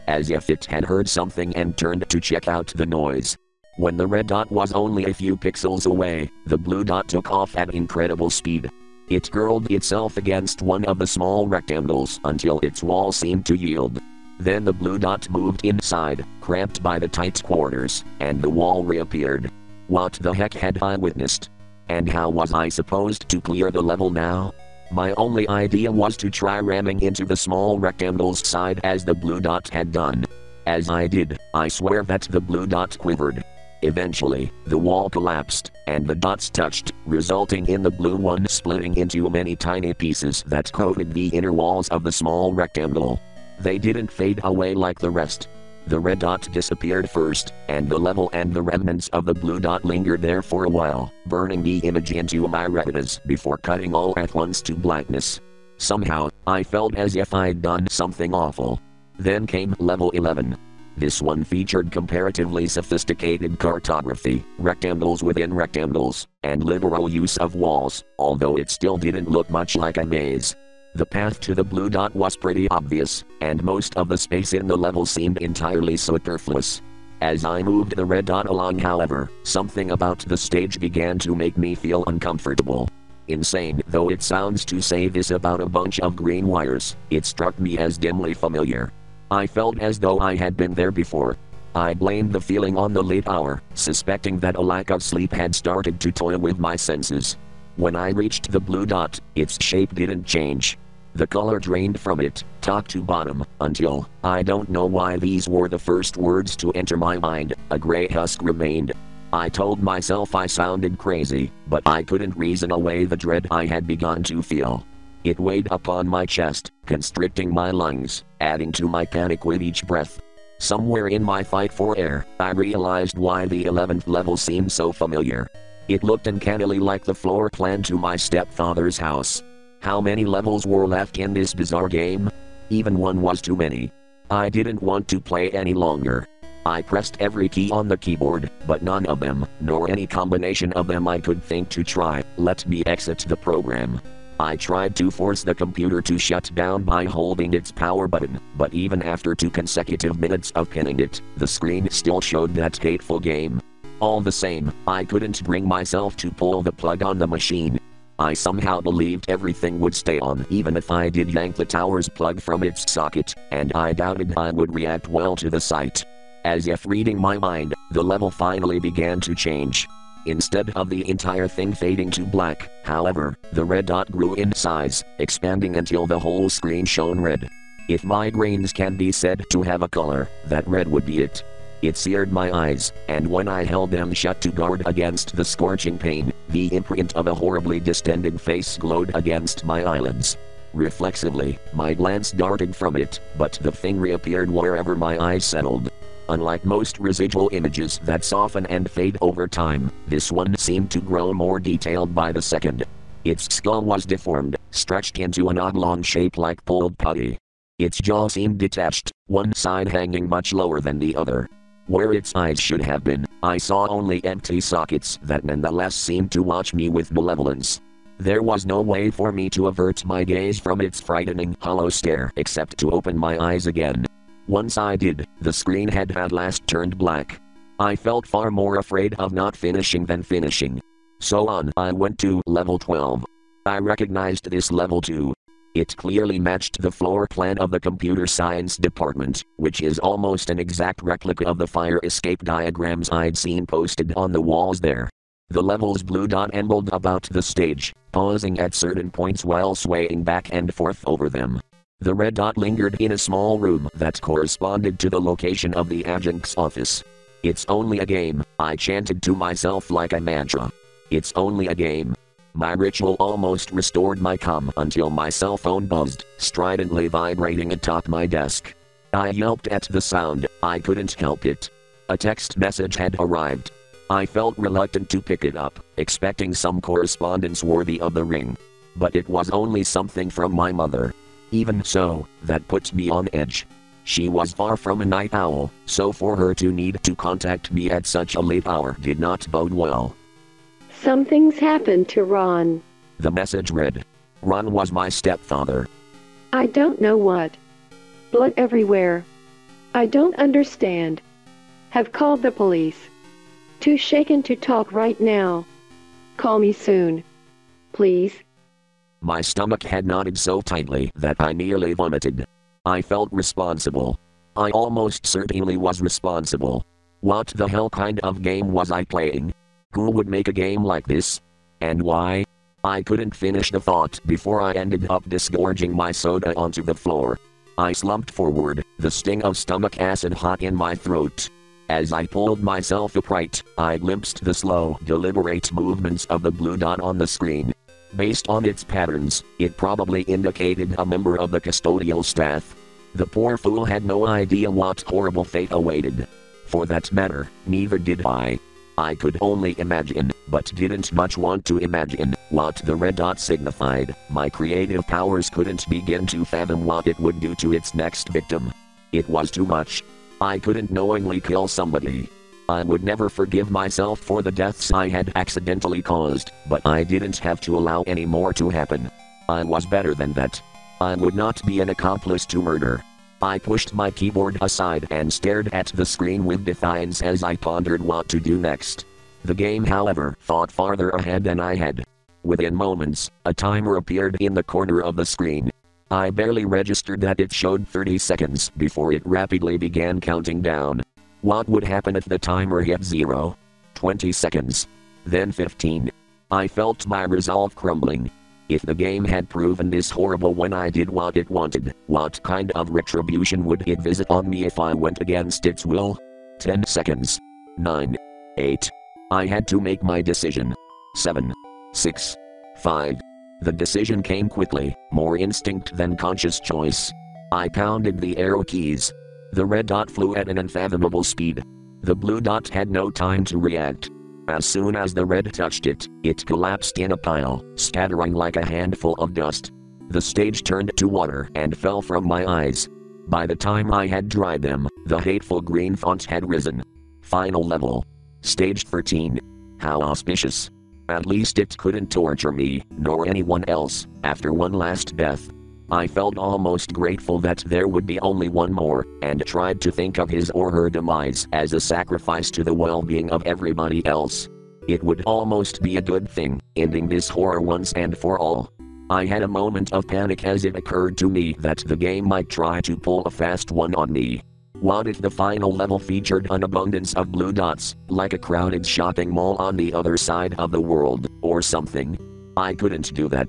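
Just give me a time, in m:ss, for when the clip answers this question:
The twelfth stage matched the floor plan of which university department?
3:57.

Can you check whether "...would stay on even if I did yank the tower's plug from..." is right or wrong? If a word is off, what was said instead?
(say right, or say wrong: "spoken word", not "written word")
right.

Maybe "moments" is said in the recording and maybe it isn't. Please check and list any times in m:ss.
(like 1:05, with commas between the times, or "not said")
6:22, 7:39.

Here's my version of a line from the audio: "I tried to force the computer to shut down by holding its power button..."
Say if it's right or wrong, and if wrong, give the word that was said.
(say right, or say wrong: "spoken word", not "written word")
right.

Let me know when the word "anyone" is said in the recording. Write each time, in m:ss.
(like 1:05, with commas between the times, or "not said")
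7:23.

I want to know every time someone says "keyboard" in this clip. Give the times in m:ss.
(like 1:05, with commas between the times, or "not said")
2:17, 6:14.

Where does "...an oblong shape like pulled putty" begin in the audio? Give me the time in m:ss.
3:25.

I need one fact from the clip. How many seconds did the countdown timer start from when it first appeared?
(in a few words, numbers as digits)
30.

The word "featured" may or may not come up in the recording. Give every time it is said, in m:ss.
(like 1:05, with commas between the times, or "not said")
1:01, 7:45.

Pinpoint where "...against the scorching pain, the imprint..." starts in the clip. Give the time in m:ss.
3:04.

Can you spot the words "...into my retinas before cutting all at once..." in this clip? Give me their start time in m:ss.
0:52.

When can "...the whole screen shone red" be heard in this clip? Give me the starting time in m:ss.
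2:56.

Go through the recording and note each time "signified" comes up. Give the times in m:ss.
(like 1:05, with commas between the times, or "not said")
5:53.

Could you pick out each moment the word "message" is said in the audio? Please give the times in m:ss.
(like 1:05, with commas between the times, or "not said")
4:32, 4:53.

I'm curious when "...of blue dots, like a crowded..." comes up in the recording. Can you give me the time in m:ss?
7:47.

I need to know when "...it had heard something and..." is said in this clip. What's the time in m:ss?
0:00.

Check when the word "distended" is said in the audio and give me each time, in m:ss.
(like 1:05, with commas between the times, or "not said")
3:07.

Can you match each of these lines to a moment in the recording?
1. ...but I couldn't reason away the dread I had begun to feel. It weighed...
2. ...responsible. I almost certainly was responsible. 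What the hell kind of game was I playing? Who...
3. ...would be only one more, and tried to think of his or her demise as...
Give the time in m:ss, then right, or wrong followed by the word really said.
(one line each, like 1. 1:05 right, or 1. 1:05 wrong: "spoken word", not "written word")
1. 1:51 right
2. 5:13 right
3. 7:27 right.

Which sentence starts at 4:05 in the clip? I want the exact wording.
The level's blue dot ambled about the stage, pausing at certain points while swaying back and forth over them.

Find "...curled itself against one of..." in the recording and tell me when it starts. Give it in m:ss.
0:09.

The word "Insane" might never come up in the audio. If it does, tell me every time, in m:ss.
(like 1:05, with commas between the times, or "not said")
1:23.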